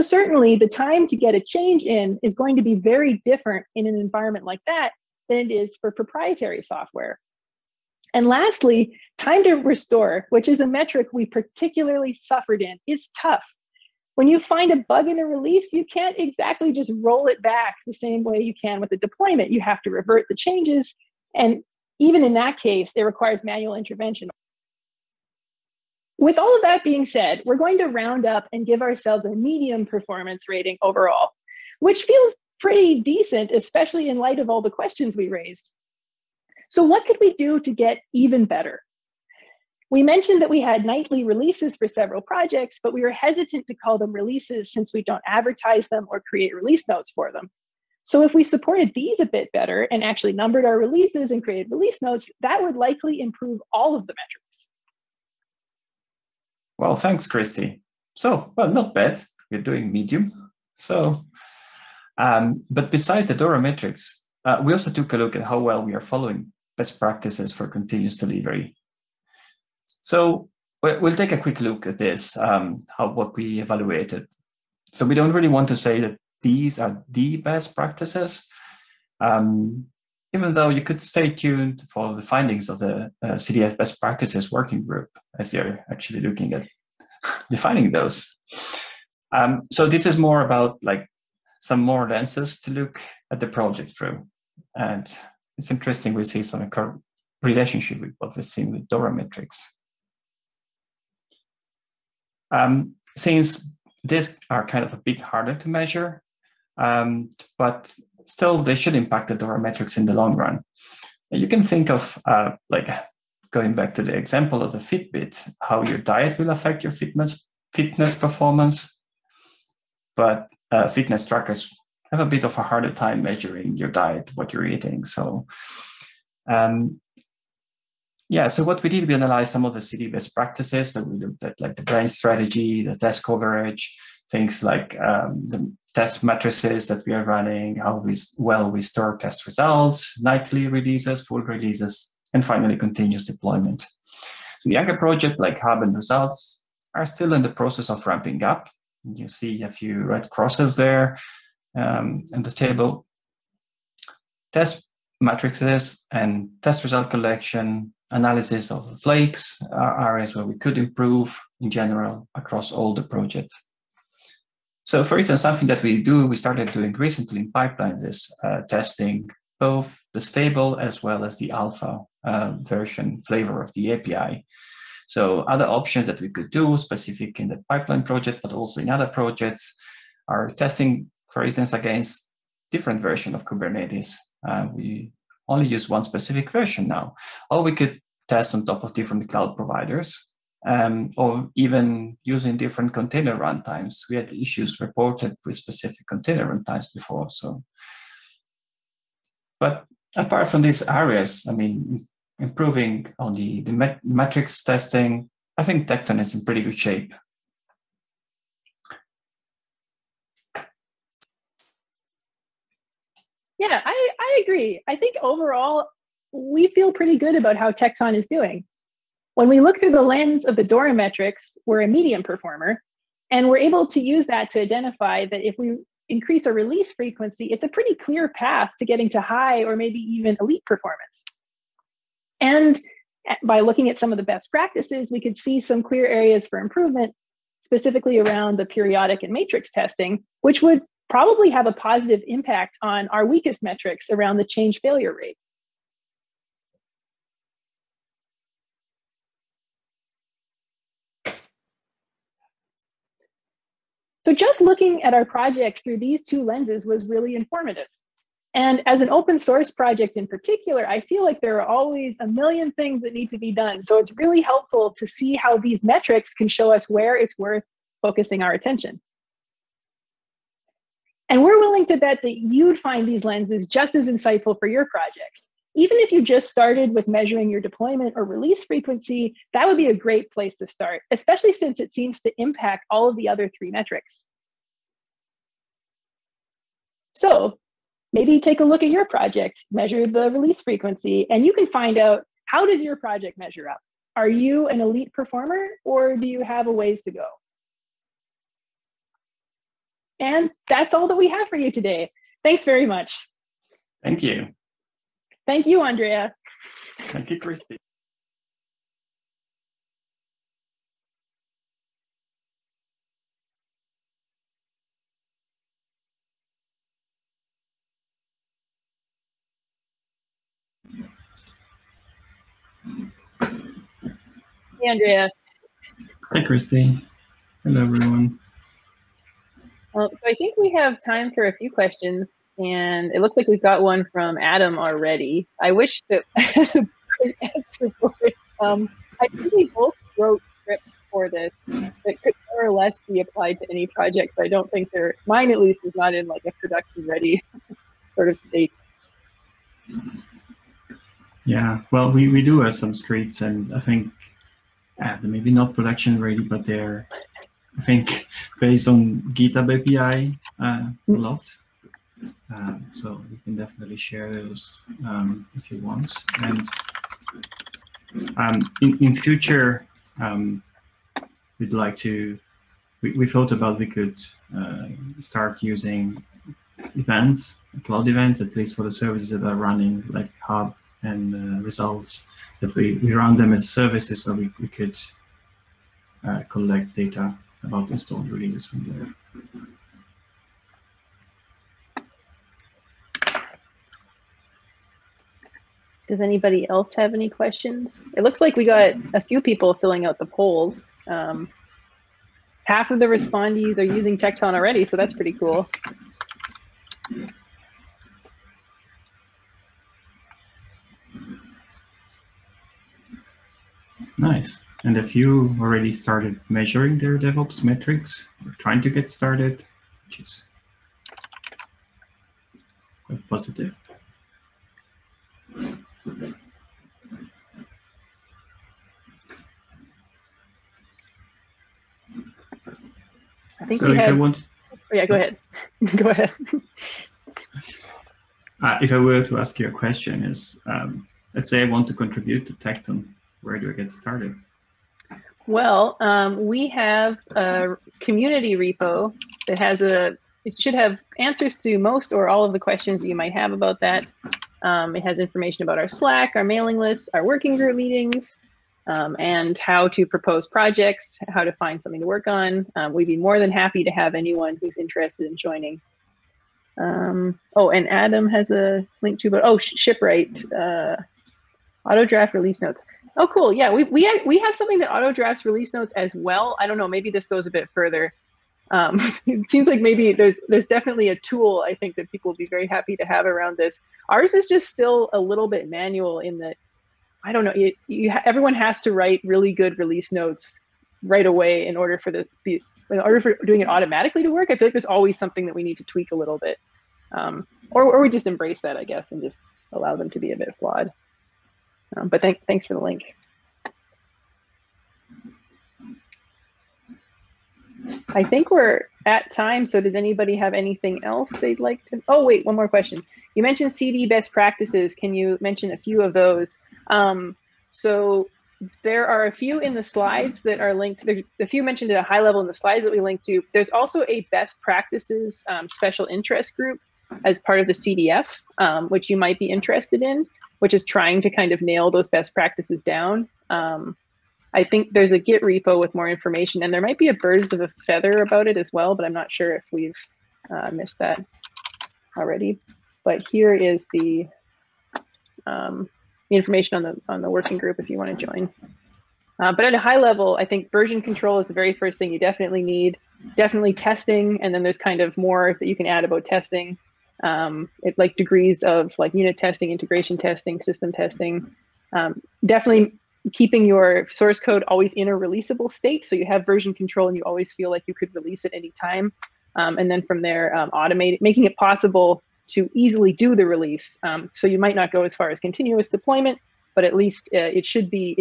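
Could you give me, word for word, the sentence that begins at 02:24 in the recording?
So Younger project like Hub and Results are still in the process of ramping up.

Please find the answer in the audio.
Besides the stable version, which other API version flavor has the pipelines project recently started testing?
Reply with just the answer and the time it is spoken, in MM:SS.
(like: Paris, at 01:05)
alpha, at 02:51.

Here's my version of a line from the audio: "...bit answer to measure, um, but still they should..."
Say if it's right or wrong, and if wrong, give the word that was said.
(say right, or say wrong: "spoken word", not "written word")
wrong: "harder", not "answer".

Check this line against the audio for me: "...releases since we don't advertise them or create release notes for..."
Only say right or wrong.
right.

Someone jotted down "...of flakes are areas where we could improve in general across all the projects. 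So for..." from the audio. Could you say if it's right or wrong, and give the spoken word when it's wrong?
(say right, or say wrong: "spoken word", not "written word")
right.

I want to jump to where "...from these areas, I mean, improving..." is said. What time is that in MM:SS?
03:20.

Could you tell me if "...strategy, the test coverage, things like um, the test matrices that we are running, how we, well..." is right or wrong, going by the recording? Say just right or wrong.
right.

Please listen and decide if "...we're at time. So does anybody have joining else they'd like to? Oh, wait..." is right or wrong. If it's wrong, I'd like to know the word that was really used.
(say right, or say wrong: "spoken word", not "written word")
wrong: "anything", not "joining".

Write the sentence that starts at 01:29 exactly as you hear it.
Um, so this is more about like some more lenses to look at the project through.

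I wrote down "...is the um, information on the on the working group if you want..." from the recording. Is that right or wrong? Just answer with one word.
right.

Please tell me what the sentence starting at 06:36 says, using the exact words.
Does anybody else have any questions?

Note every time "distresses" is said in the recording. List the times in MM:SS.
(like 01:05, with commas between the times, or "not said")
not said.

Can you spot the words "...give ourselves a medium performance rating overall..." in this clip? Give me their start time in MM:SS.
00:28.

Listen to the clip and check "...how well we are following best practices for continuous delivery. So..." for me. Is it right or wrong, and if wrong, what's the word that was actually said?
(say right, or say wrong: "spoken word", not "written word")
right.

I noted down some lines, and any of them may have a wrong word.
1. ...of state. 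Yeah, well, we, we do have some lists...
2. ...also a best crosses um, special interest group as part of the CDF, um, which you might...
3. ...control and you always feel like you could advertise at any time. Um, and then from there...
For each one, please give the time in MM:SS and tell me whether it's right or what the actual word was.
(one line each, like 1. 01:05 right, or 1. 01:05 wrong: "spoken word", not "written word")
1. 05:48 wrong: "scripts", not "lists"
2. 08:43 wrong: "practices", not "crosses"
3. 09:26 wrong: "release", not "advertise".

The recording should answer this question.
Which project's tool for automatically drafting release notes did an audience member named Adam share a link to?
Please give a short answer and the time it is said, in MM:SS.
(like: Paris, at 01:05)
Shipwright, at 07:49.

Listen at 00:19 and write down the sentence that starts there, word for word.
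You have to revert the changes and even in that case, it requires manual intervention.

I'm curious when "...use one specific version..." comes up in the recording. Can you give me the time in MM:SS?
03:05.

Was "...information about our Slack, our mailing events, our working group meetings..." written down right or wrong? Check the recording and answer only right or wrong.
wrong.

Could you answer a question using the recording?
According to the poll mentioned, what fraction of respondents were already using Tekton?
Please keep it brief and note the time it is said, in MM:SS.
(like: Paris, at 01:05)
half, at 06:42.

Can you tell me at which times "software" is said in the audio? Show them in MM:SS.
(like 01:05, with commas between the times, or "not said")
00:06.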